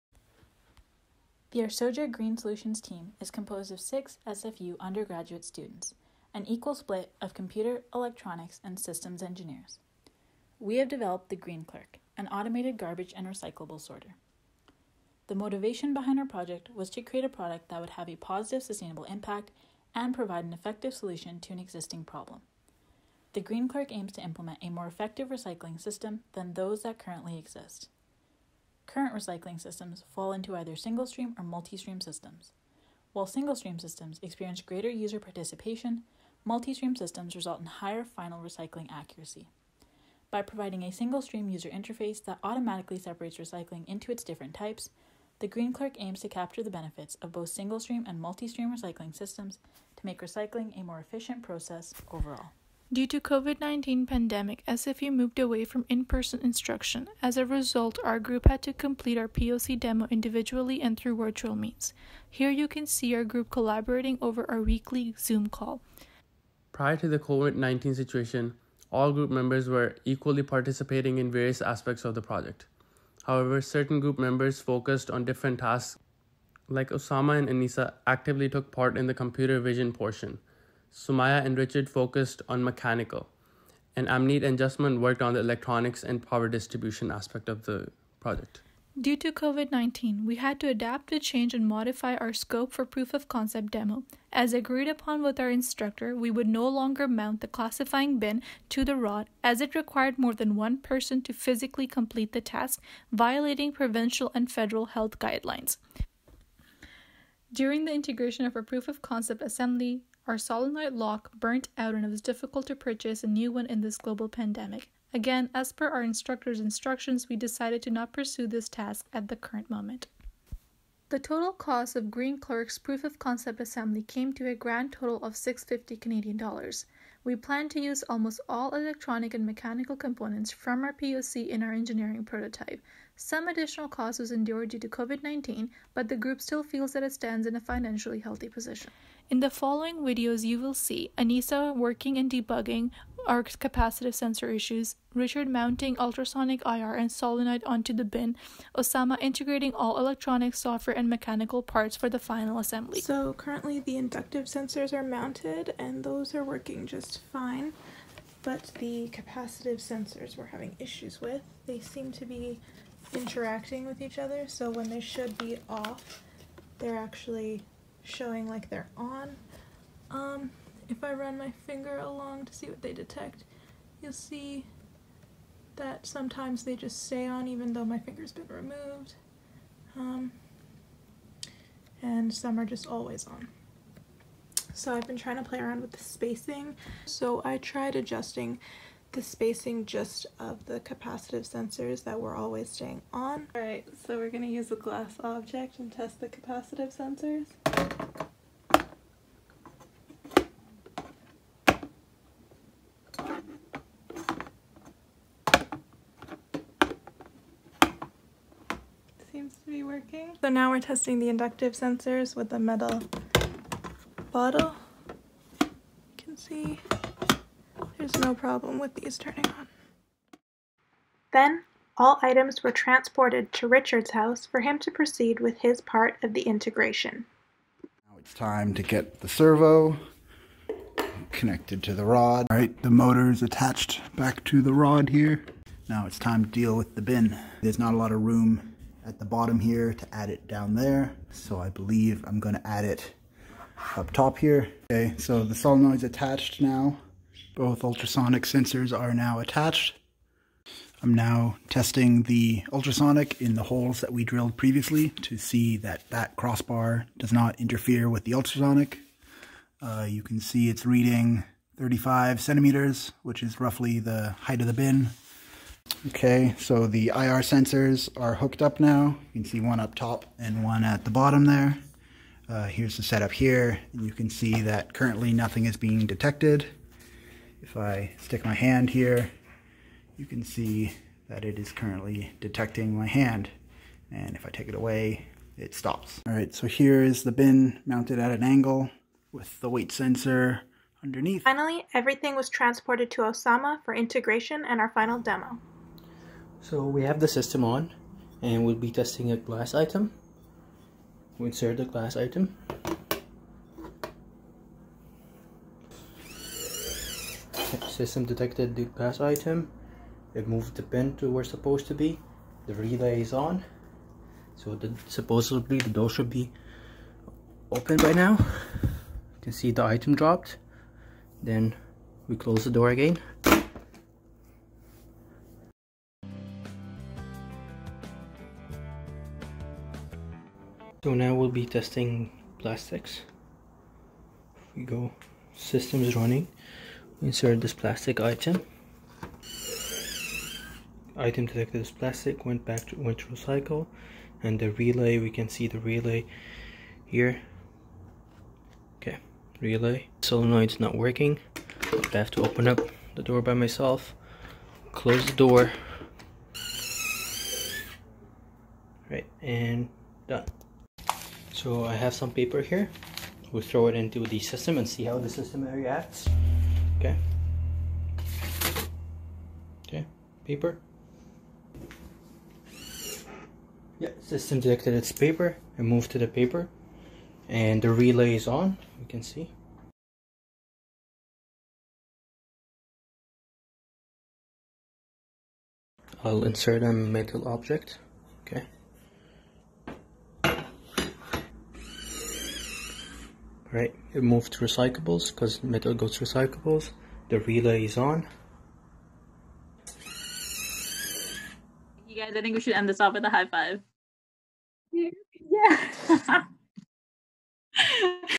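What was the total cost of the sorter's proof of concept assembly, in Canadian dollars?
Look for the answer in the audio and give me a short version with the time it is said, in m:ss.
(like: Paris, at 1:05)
650, at 2:05.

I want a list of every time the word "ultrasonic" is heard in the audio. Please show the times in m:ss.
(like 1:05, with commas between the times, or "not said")
2:25, 4:07, 4:12, 4:18.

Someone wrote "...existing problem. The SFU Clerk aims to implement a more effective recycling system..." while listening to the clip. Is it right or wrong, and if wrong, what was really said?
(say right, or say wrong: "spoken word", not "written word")
wrong: "Green", not "SFU".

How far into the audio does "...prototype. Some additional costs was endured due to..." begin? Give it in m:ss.
2:12.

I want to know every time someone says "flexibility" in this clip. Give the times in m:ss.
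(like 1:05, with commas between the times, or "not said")
not said.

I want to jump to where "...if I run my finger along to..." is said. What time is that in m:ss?
2:50.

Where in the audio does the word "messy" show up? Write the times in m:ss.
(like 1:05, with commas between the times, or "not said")
not said.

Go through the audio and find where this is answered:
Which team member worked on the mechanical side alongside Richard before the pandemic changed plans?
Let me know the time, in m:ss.
1:20.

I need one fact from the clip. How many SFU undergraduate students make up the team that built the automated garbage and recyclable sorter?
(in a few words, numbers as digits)
6.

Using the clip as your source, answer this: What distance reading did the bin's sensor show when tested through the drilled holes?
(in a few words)
35 centimeters.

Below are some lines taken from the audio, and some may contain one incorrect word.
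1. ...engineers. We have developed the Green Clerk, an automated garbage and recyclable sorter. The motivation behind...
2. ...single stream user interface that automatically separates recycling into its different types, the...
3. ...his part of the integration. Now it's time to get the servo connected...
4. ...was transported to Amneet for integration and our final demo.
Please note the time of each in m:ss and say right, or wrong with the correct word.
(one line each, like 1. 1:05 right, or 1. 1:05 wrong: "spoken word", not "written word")
1. 0:09 right
2. 0:40 right
3. 3:45 right
4. 4:52 wrong: "Osama", not "Amneet".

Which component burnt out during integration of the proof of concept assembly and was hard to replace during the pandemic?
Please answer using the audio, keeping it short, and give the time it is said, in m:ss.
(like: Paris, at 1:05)
solenoid lock, at 1:50.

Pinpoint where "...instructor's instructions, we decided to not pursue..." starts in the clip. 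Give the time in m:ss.
1:56.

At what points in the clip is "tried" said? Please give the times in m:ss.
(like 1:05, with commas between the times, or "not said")
3:07.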